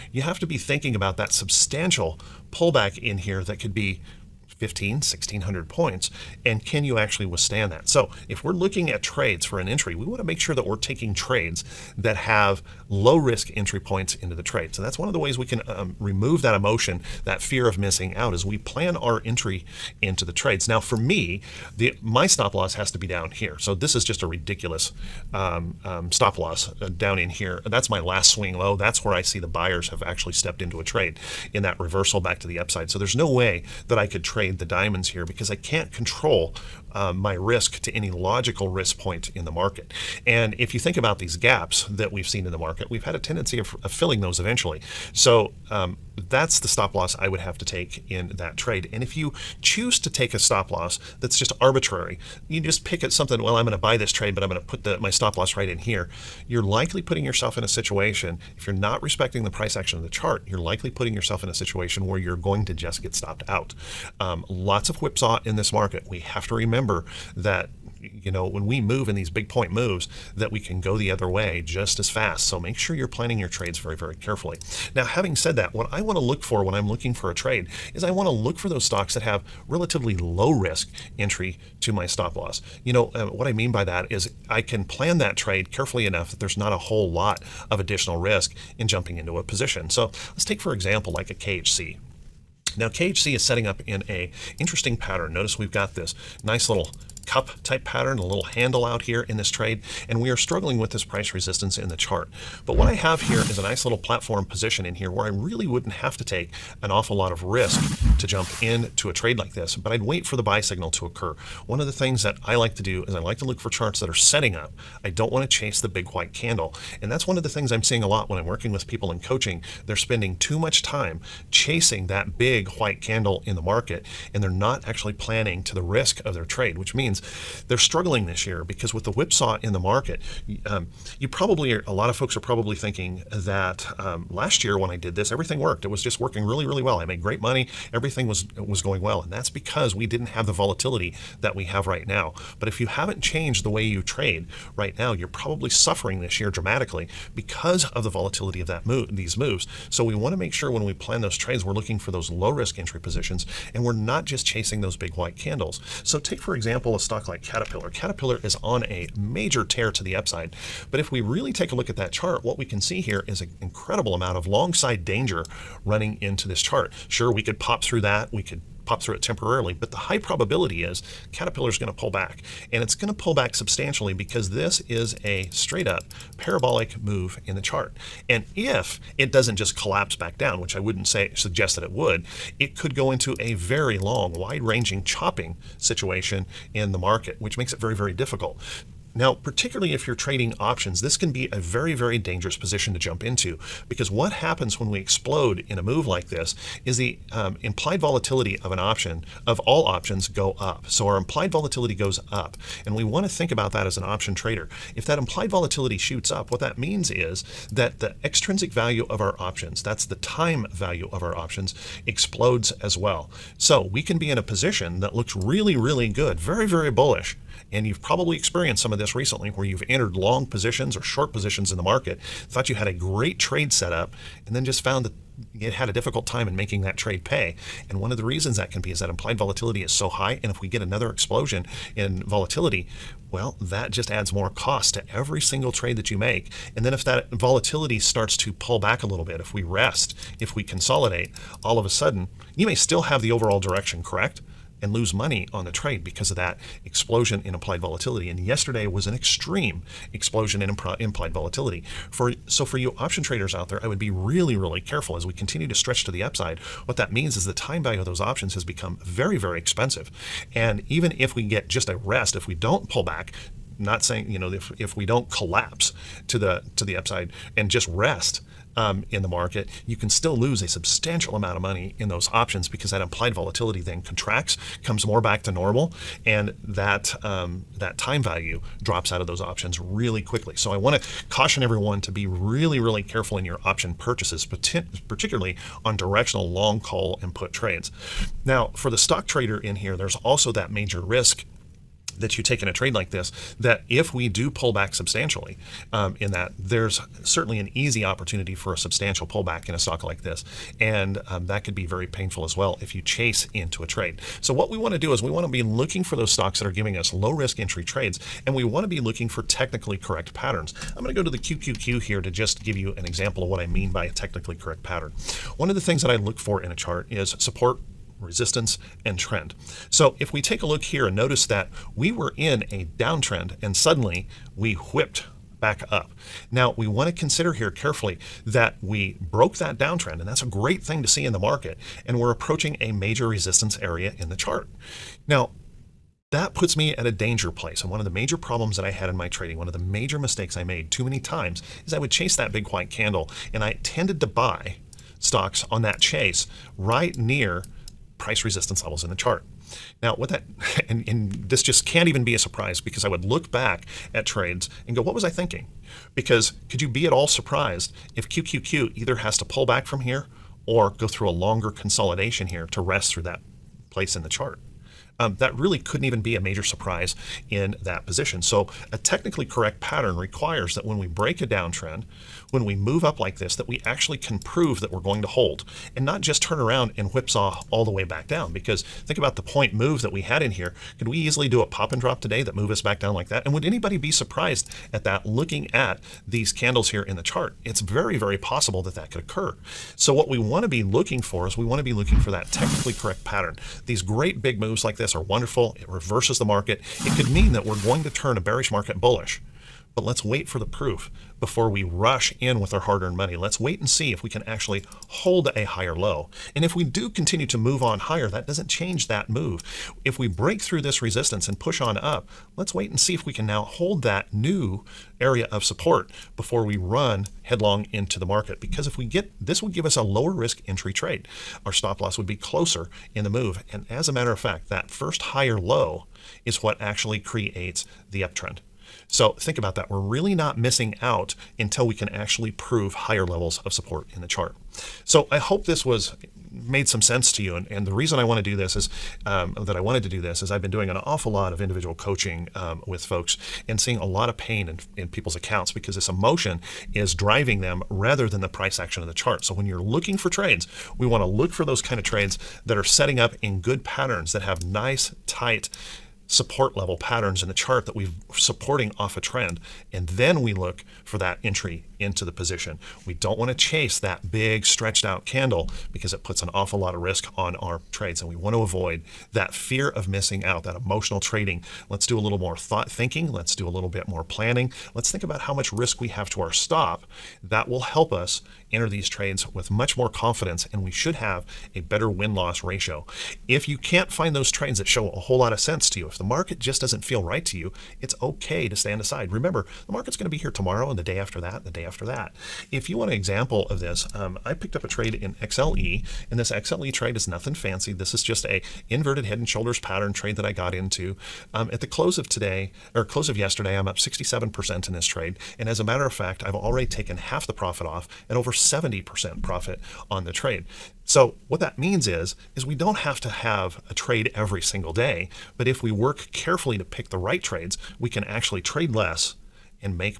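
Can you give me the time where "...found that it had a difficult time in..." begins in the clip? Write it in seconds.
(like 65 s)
224 s.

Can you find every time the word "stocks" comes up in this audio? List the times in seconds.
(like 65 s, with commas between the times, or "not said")
78 s, 156 s, 288 s, 299 s, 306 s, 345 s.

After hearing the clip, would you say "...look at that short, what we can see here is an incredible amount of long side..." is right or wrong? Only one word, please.
wrong.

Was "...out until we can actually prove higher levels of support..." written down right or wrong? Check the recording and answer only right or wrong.
right.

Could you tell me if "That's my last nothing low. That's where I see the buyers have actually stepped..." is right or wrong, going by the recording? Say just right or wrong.
wrong.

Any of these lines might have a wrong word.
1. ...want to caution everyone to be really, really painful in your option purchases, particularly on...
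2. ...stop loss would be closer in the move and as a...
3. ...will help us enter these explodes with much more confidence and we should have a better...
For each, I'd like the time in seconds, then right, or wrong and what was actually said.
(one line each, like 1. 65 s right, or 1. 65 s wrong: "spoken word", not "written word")
1. 280 s wrong: "careful", not "painful"
2. 421 s right
3. 477 s wrong: "trades", not "explodes".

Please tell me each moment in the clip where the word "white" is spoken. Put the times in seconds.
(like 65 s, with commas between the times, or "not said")
116 s, 122 s, 155 s, 342 s.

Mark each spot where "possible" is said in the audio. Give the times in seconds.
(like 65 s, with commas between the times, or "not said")
388 s.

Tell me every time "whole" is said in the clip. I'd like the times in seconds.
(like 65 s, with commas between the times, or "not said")
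86 s, 485 s.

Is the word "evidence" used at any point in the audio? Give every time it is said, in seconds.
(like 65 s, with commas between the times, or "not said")
not said.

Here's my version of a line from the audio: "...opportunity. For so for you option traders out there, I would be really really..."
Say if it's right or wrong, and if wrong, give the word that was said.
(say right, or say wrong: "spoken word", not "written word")
wrong: "volatility", not "opportunity".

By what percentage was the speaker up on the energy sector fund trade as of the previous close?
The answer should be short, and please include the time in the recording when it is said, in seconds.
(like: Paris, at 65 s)
67%, at 503 s.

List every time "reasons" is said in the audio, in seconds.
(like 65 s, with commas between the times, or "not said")
228 s, 437 s.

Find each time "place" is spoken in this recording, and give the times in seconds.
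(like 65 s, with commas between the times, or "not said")
337 s, 363 s.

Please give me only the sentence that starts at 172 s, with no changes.
And it's going to pull back substantially because this is a straight up parabolic move in the chart.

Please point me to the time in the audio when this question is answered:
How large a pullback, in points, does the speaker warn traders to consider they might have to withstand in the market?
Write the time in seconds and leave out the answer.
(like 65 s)
4 s.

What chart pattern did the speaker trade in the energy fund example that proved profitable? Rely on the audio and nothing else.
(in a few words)
Inverted head and shoulders.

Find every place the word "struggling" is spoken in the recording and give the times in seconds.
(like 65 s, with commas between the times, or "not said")
100 s, 127 s.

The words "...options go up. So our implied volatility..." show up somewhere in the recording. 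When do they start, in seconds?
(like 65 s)
199 s.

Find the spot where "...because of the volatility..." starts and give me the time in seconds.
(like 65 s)
147 s.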